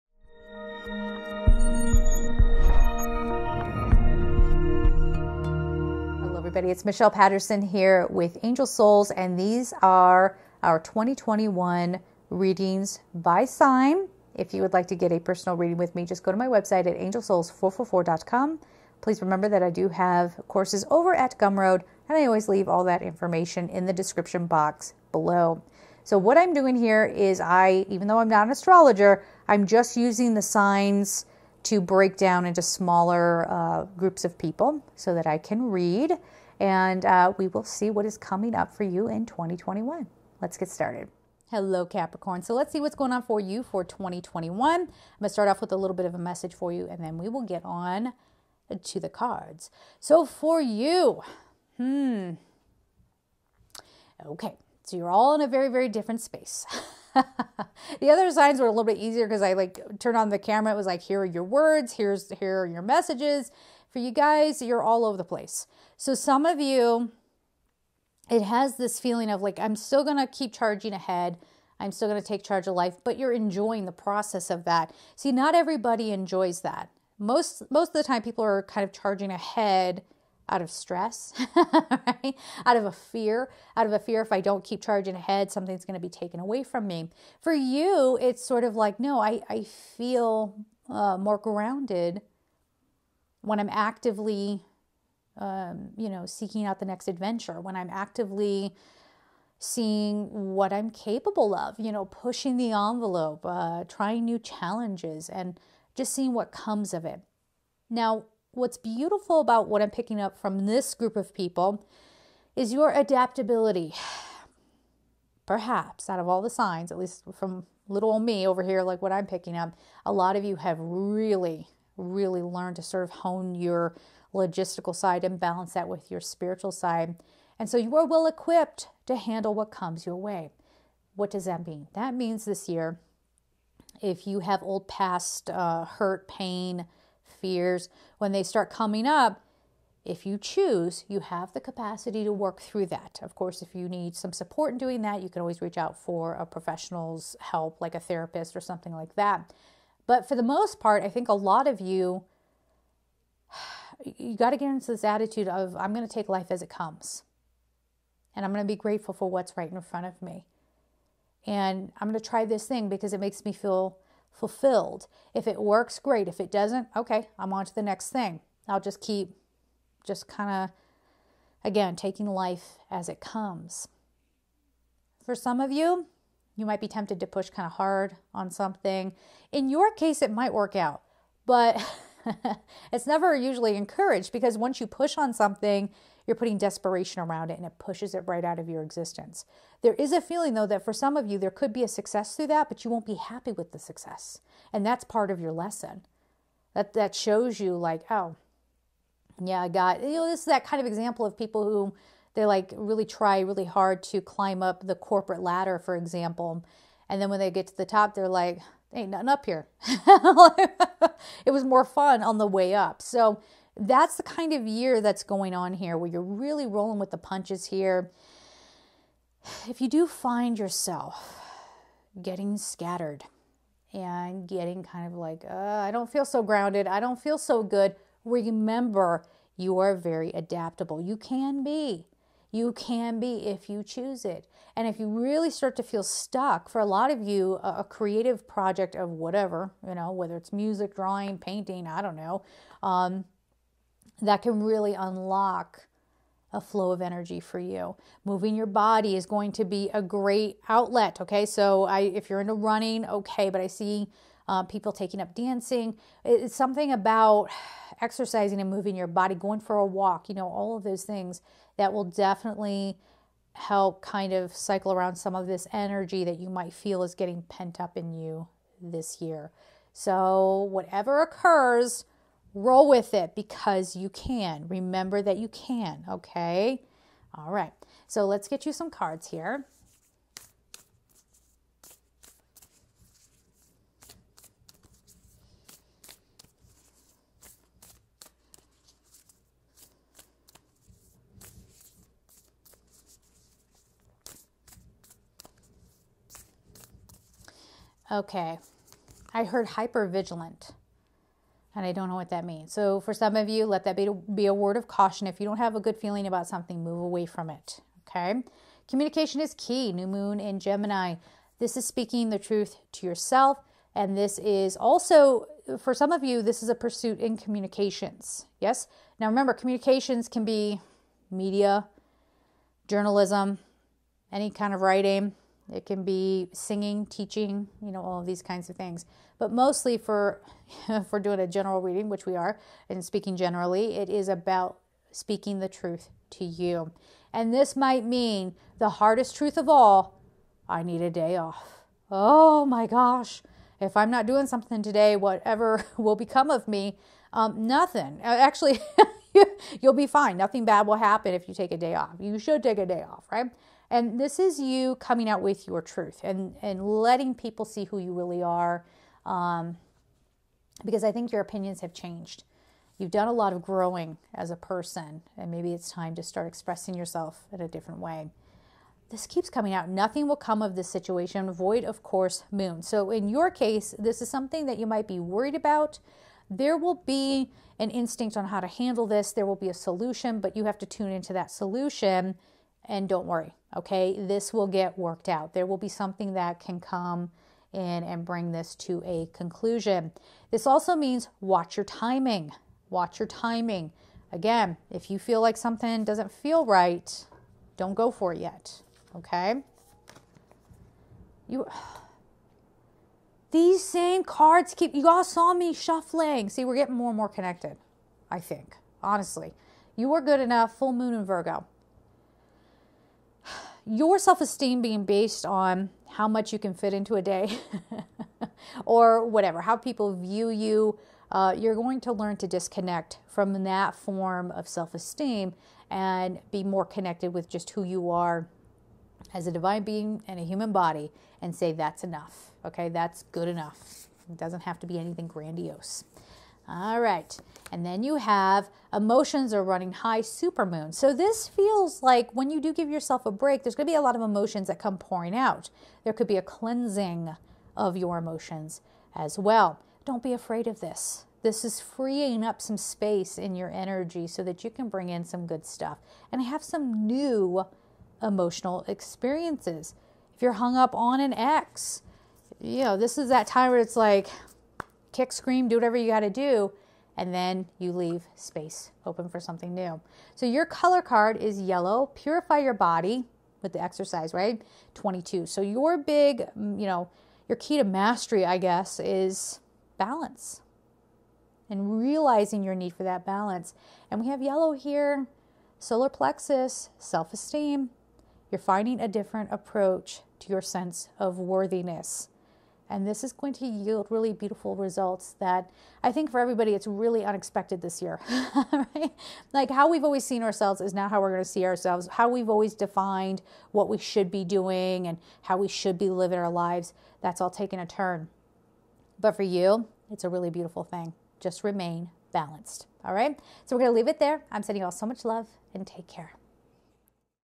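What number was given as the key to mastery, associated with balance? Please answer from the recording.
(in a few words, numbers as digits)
22.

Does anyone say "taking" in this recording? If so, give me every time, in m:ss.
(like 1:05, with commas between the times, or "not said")
2:51, 4:14.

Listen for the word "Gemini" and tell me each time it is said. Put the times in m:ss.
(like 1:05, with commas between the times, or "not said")
5:10.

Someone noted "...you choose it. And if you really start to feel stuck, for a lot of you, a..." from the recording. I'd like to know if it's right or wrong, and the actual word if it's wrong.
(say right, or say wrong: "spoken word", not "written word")
right.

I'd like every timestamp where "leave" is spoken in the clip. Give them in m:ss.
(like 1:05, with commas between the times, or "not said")
0:22, 7:47, 8:33.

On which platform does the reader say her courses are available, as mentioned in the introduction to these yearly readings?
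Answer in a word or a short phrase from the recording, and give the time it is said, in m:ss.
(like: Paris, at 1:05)
Gumroad, at 0:21.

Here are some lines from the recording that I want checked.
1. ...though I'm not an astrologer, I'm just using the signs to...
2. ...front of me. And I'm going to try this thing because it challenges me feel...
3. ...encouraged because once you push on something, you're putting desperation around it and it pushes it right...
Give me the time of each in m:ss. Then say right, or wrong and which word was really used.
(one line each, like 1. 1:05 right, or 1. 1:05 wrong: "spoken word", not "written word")
1. 0:28 right
2. 2:39 wrong: "makes", not "challenges"
3. 3:03 right.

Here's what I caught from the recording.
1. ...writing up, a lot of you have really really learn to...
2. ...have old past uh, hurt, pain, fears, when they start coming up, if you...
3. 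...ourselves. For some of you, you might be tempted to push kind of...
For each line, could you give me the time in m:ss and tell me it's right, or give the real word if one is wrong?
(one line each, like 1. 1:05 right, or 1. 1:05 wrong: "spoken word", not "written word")
1. 1:59 wrong: "picking", not "writing"
2. 2:14 right
3. 2:53 wrong: "comes", not "ourselves".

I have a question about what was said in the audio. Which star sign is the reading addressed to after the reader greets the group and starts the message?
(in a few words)
Capricorn.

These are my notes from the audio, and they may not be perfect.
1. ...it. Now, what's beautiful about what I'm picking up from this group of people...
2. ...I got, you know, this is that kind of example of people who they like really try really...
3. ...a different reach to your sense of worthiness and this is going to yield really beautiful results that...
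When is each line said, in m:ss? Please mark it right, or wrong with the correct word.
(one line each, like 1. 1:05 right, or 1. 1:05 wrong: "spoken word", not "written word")
1. 1:47 right
2. 3:19 right
3. 8:08 wrong: "approach", not "reach".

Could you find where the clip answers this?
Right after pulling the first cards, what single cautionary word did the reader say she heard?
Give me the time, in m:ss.
4:59.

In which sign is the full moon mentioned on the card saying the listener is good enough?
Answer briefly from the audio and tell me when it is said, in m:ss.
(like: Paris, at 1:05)
Virgo, at 6:51.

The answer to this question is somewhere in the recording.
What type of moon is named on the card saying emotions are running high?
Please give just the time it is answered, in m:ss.
7:20.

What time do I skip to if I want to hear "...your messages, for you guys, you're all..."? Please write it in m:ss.
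1:02.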